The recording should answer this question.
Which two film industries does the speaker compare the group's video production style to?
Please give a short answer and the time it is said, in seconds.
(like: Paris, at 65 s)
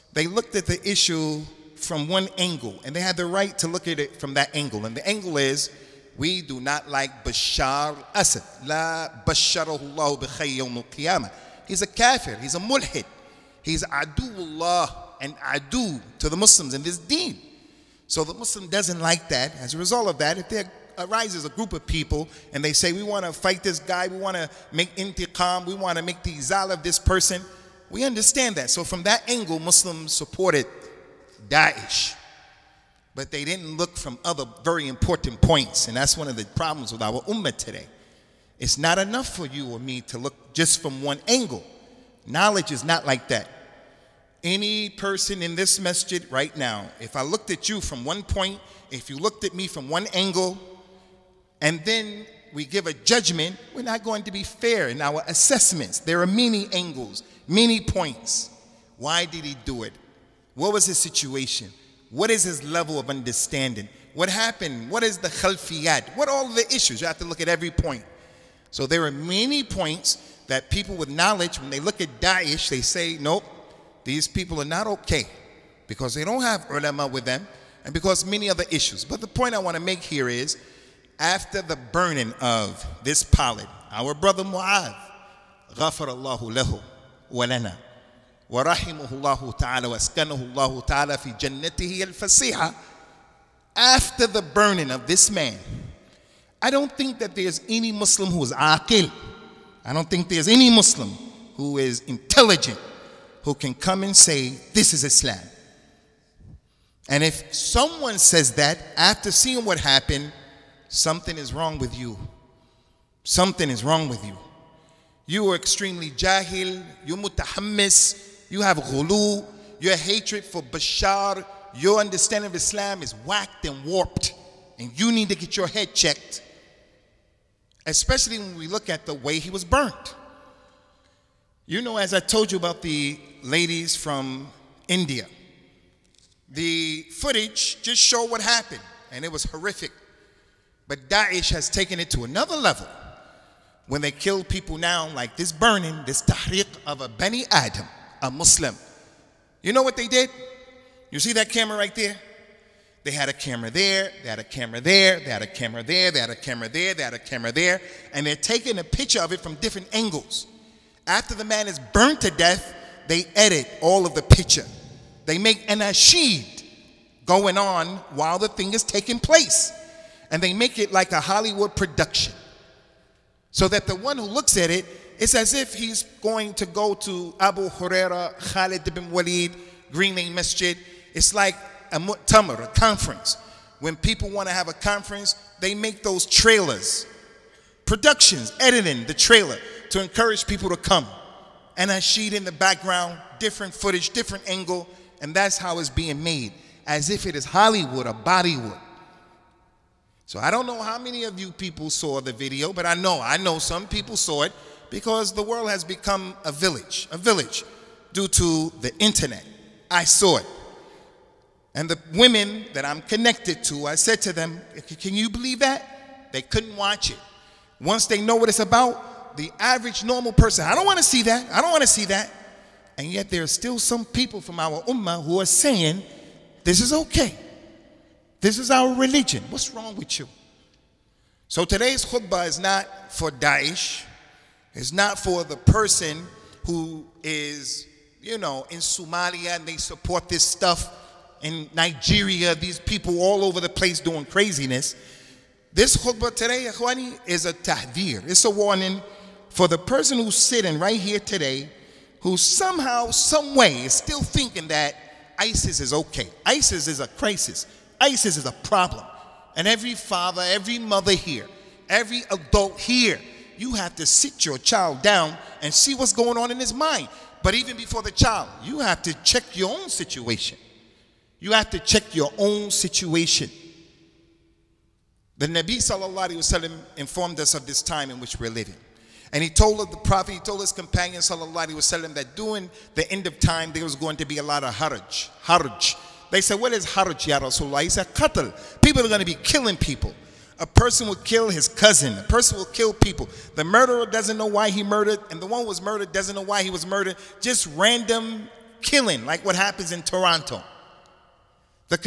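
Hollywood or Bollywood, at 197 s.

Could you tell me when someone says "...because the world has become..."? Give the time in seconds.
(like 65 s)
204 s.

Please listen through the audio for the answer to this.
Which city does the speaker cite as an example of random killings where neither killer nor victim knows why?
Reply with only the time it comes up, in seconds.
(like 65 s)
300 s.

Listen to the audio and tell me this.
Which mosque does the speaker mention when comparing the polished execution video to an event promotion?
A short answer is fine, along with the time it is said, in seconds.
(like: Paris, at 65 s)
Green Lane Masjid, at 179 s.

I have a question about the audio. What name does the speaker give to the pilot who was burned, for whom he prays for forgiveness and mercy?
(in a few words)
Mu'adh.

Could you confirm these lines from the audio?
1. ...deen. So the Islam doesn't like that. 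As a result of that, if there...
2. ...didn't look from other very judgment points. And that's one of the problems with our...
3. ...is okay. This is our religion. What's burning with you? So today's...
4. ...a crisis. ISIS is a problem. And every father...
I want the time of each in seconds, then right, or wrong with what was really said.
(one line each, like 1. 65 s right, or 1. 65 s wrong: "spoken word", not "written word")
1. 16 s wrong: "Muslim", not "Islam"
2. 33 s wrong: "important", not "judgment"
3. 226 s wrong: "wrong", not "burning"
4. 257 s right.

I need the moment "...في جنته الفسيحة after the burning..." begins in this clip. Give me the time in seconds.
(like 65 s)
91 s.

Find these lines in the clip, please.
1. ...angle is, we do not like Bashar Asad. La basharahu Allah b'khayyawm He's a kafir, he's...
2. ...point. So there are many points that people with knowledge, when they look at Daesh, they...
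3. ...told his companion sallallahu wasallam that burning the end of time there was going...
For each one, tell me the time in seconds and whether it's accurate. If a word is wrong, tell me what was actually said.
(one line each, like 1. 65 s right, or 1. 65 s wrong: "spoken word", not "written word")
1. 5 s right
2. 67 s right
3. 280 s wrong: "during", not "burning".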